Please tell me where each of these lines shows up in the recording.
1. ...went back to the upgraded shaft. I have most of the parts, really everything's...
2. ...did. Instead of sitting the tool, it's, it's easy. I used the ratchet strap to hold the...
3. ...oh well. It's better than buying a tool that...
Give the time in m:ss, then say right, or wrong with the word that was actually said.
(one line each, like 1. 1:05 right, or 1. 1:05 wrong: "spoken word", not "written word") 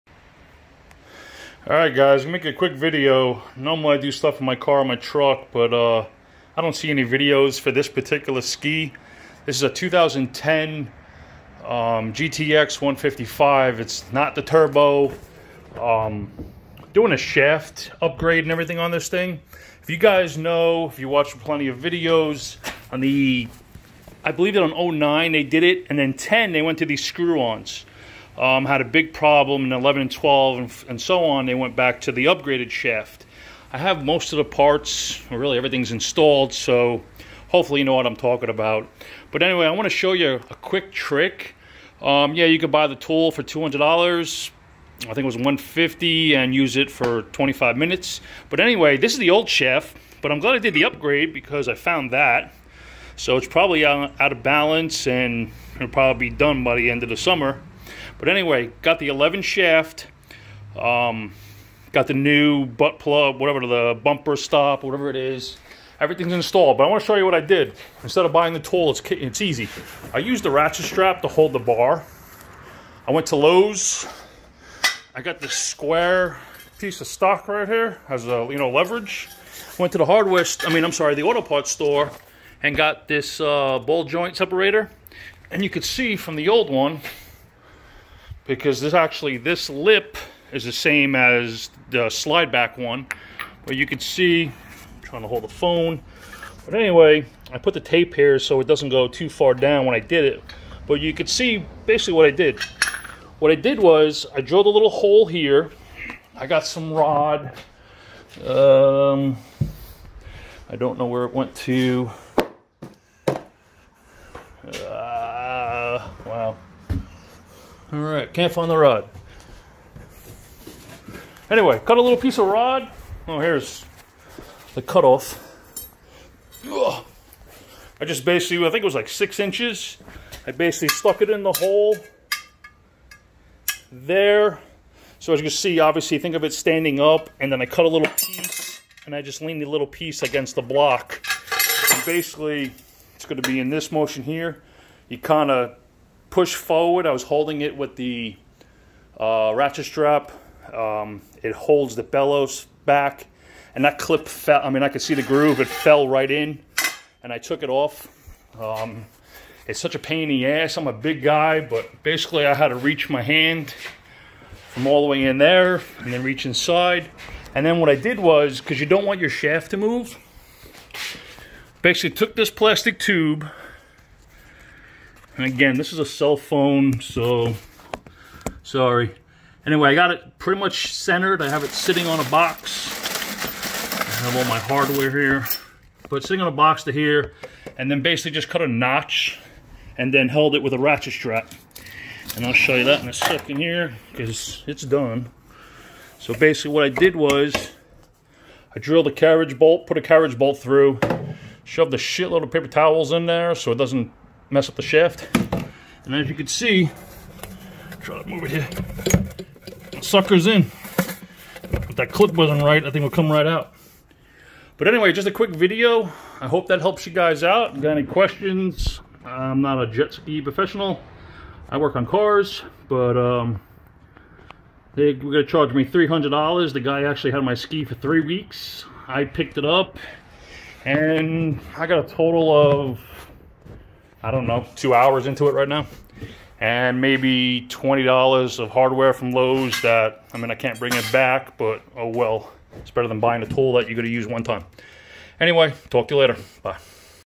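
1. 0:31 right
2. 1:07 wrong: "buying", not "sitting"
3. 4:01 right.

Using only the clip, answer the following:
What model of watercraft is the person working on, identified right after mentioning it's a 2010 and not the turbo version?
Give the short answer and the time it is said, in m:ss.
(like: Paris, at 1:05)
GTX 155, at 0:12.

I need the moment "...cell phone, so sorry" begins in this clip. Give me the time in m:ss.
2:56.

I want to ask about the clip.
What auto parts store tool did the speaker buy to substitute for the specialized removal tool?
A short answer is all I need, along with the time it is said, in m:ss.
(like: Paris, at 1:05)
ball joint separator, at 1:23.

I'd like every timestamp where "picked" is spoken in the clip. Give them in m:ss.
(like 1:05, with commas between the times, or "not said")
3:49.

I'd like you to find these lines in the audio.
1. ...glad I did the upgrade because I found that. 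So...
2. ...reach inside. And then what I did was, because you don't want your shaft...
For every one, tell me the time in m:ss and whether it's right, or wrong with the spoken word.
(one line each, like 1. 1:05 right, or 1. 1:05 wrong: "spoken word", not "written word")
1. 0:50 right
2. 2:46 right.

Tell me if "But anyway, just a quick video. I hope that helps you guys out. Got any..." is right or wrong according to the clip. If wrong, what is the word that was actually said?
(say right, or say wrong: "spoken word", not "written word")
right.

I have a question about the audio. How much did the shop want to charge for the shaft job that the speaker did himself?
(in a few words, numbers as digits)
$300.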